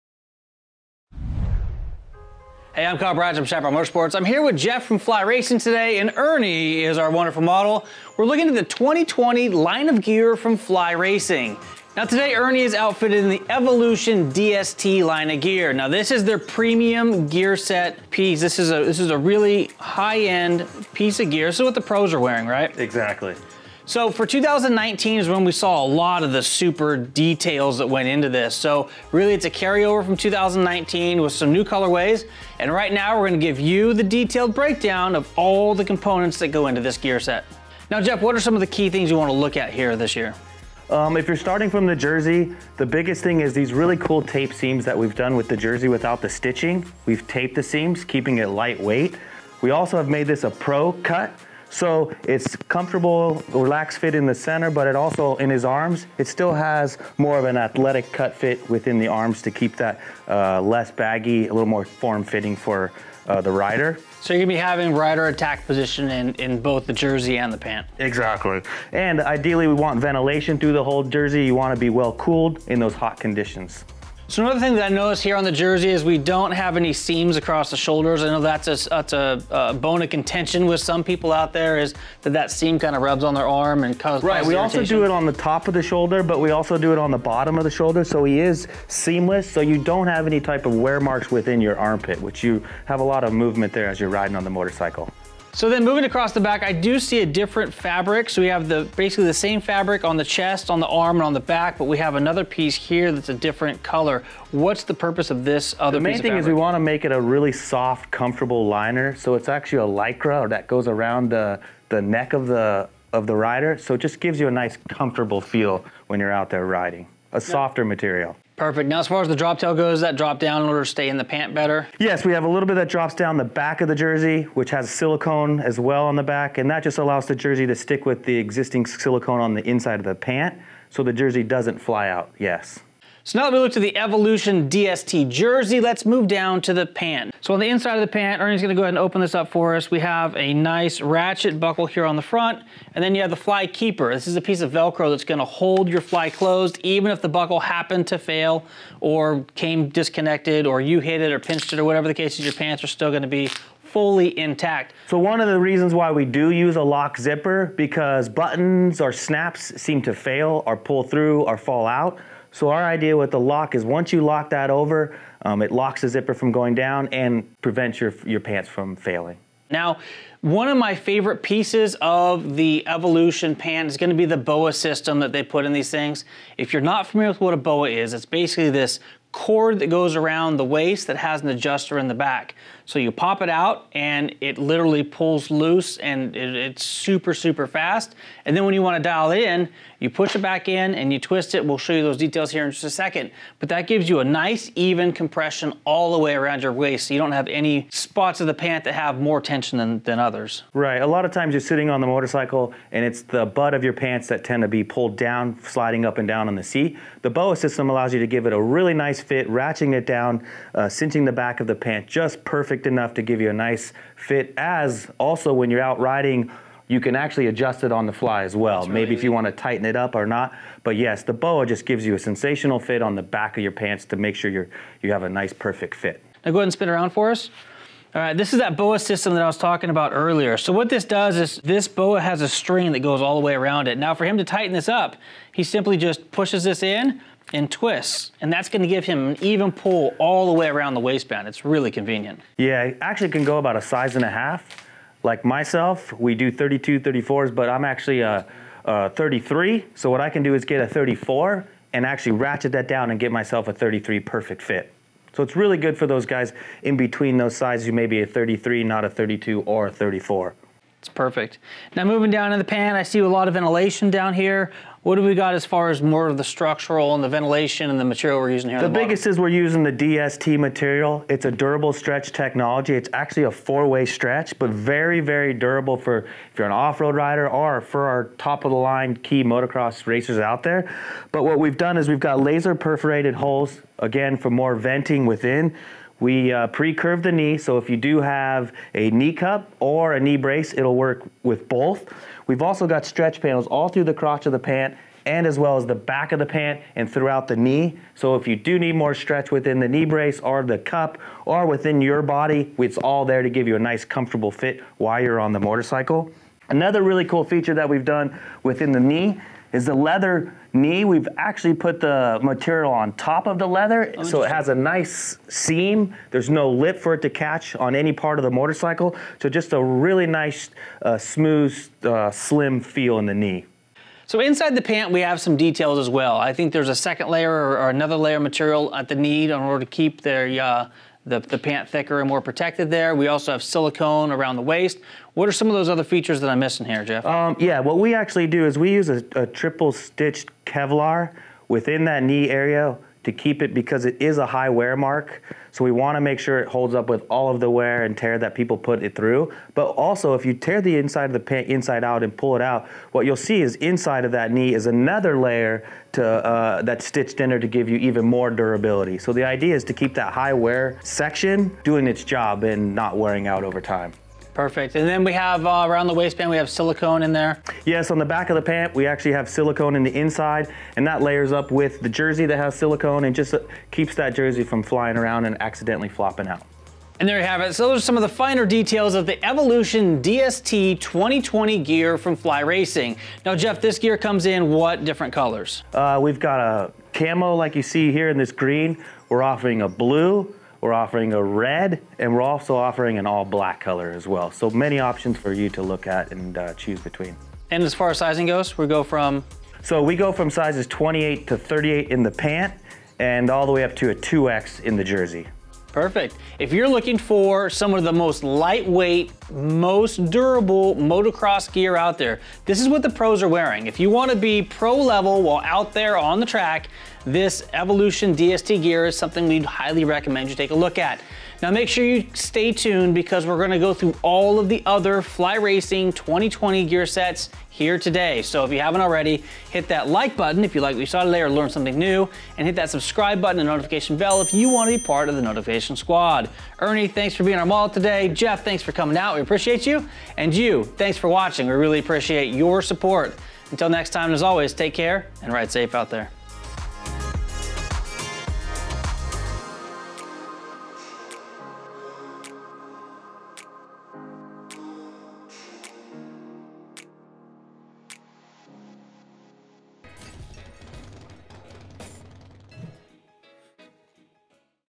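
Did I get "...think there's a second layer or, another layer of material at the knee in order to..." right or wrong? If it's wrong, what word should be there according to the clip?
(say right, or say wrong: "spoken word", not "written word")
right.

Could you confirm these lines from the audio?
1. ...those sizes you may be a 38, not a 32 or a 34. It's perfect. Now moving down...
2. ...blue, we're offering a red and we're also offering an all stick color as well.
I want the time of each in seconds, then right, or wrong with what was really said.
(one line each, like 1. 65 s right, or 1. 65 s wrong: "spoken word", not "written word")
1. 257 s wrong: "33", not "38"
2. 389 s wrong: "black", not "stick".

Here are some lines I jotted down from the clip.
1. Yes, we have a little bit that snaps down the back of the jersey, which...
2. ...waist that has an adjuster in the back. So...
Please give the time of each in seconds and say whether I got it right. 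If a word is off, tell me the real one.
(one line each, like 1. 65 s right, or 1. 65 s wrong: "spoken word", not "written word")
1. 121 s wrong: "drops", not "snaps"
2. 180 s right.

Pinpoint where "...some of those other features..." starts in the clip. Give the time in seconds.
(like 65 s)
335 s.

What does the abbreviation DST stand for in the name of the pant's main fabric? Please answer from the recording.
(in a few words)
Durable stretch technology.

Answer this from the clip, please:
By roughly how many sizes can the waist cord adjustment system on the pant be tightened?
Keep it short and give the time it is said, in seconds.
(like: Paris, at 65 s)
1.5 sizes, at 243 s.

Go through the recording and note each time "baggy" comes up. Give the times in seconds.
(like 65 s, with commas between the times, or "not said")
60 s.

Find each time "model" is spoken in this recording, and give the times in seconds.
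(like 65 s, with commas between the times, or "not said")
7 s, 437 s.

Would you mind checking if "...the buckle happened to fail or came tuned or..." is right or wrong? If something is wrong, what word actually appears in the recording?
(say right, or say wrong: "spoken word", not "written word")
wrong: "disconnected", not "tuned".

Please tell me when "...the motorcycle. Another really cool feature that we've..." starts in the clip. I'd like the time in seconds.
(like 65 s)
305 s.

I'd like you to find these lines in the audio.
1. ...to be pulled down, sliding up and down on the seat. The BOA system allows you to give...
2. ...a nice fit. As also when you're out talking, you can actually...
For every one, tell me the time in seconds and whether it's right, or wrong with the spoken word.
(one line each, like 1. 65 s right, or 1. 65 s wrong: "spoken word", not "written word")
1. 204 s right
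2. 213 s wrong: "riding", not "talking".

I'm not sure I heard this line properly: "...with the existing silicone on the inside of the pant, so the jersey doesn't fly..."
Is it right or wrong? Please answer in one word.
right.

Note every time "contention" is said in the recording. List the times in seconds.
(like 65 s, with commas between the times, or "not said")
80 s.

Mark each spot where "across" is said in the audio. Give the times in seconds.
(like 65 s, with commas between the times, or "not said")
77 s, 96 s.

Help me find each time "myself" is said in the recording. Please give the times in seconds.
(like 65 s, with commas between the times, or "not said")
245 s, 253 s.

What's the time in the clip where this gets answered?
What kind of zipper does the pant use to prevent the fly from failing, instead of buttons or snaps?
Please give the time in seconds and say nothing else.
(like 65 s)
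156 s.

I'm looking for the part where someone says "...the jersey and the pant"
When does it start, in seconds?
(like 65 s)
66 s.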